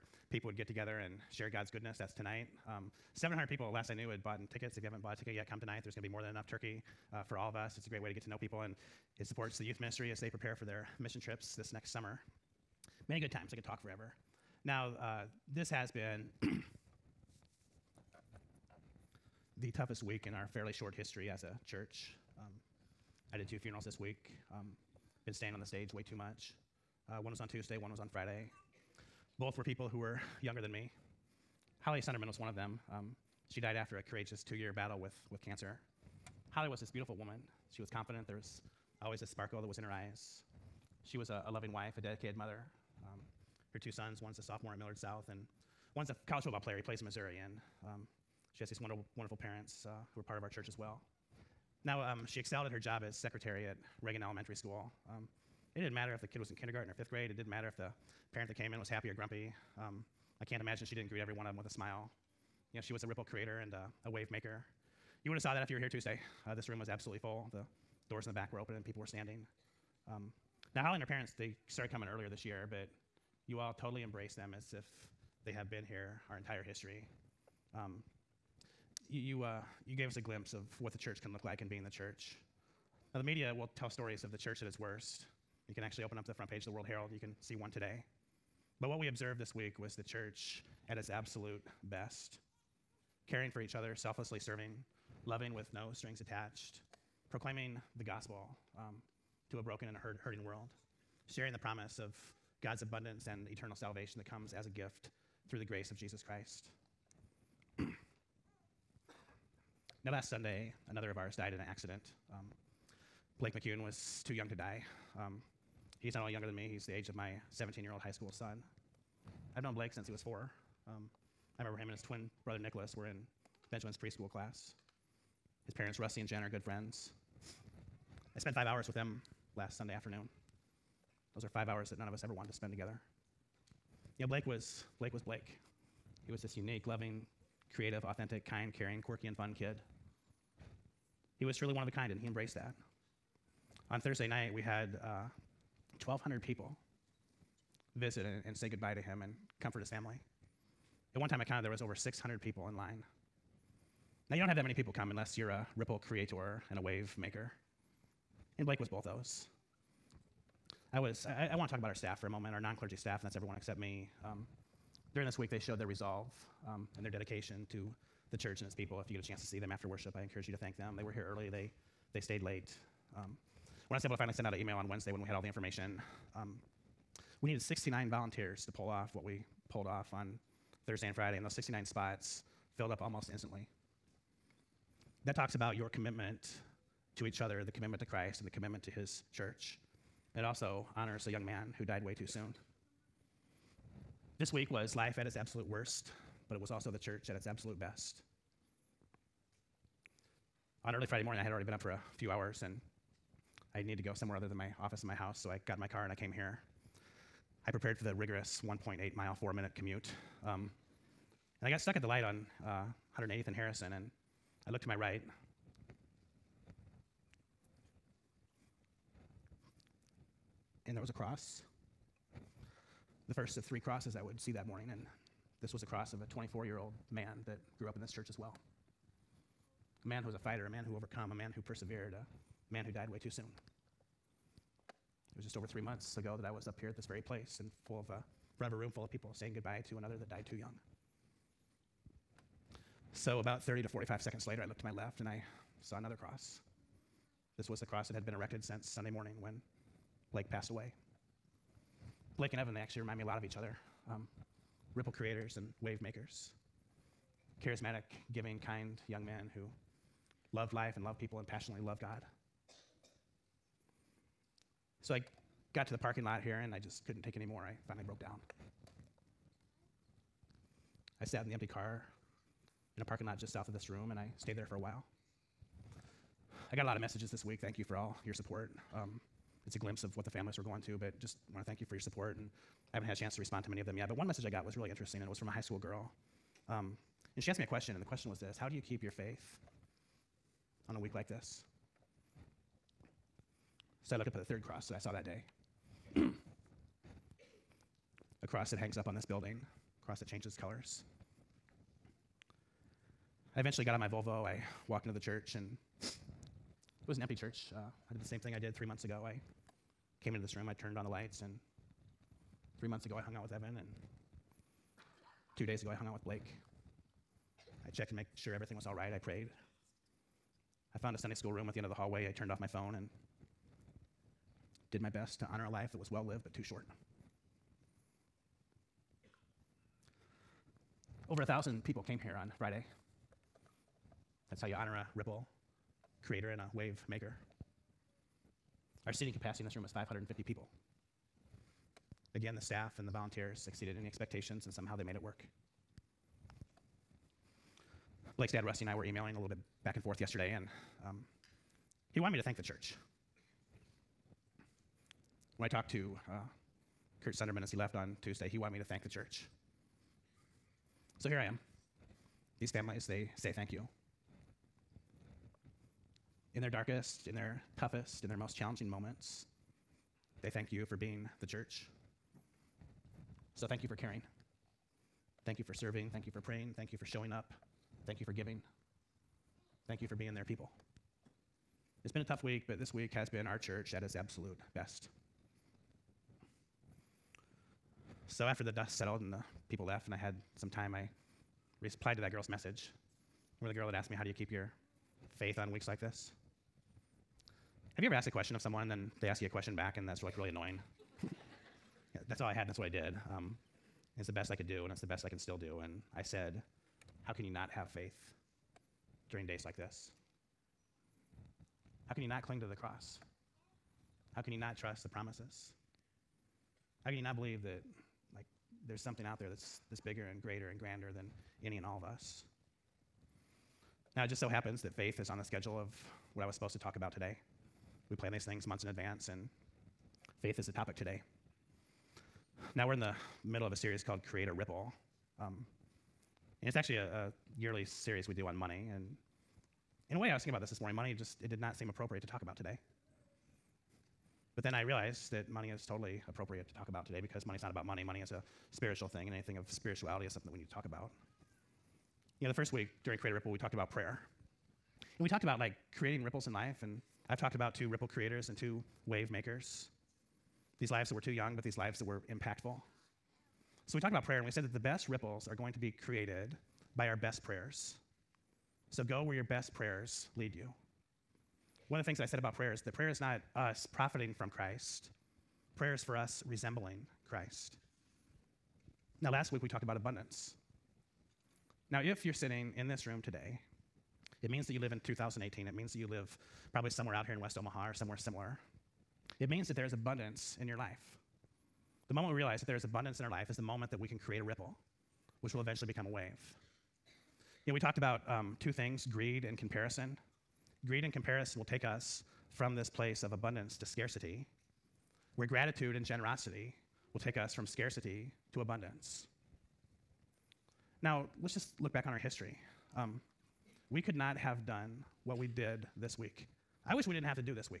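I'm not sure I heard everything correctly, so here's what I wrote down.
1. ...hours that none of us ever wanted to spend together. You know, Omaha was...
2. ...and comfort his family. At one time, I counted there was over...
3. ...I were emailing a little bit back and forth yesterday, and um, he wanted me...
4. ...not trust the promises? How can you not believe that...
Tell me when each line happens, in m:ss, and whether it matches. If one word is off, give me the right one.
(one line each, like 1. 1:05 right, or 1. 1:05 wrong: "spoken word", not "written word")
1. 2:11 wrong: "Blake", not "Omaha"
2. 2:29 right
3. 5:48 right
4. 6:54 right.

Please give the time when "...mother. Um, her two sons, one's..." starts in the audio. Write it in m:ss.
0:42.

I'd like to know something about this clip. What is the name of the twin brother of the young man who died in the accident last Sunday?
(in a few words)
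Nicholas.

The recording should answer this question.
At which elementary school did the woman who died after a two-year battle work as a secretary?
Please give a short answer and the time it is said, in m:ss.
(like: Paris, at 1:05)
Reagan Elementary School, at 0:54.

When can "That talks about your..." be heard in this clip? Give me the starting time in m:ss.
3:05.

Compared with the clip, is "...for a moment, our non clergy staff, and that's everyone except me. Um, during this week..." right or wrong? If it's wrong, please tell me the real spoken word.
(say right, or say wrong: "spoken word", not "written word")
right.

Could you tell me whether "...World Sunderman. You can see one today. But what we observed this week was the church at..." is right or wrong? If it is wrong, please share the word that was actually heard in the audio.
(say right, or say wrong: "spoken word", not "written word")
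wrong: "Herald", not "Sunderman".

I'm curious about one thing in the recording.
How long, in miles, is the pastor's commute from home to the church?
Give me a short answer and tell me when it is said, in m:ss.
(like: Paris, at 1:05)
1.8 miles, at 3:28.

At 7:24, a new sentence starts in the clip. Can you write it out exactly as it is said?
But then I realized that money is totally appropriate to talk about today because money is not about money.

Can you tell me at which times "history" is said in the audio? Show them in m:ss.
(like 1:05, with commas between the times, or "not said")
0:20, 1:16, 8:32.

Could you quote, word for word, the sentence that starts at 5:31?
Over a thousand people came here on Friday.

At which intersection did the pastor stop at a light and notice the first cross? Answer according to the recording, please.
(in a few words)
180th and Harrison.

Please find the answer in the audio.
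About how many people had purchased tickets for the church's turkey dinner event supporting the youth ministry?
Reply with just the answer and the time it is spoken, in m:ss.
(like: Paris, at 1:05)
700, at 0:03.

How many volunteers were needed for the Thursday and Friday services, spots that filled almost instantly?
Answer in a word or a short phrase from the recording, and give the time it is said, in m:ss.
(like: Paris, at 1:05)
69, at 2:57.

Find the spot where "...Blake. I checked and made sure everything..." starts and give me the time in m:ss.
5:16.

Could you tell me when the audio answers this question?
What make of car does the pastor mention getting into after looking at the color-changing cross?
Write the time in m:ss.
5:04.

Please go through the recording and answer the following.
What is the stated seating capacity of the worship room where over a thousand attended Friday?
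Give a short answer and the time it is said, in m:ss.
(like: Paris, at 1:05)
550, at 5:39.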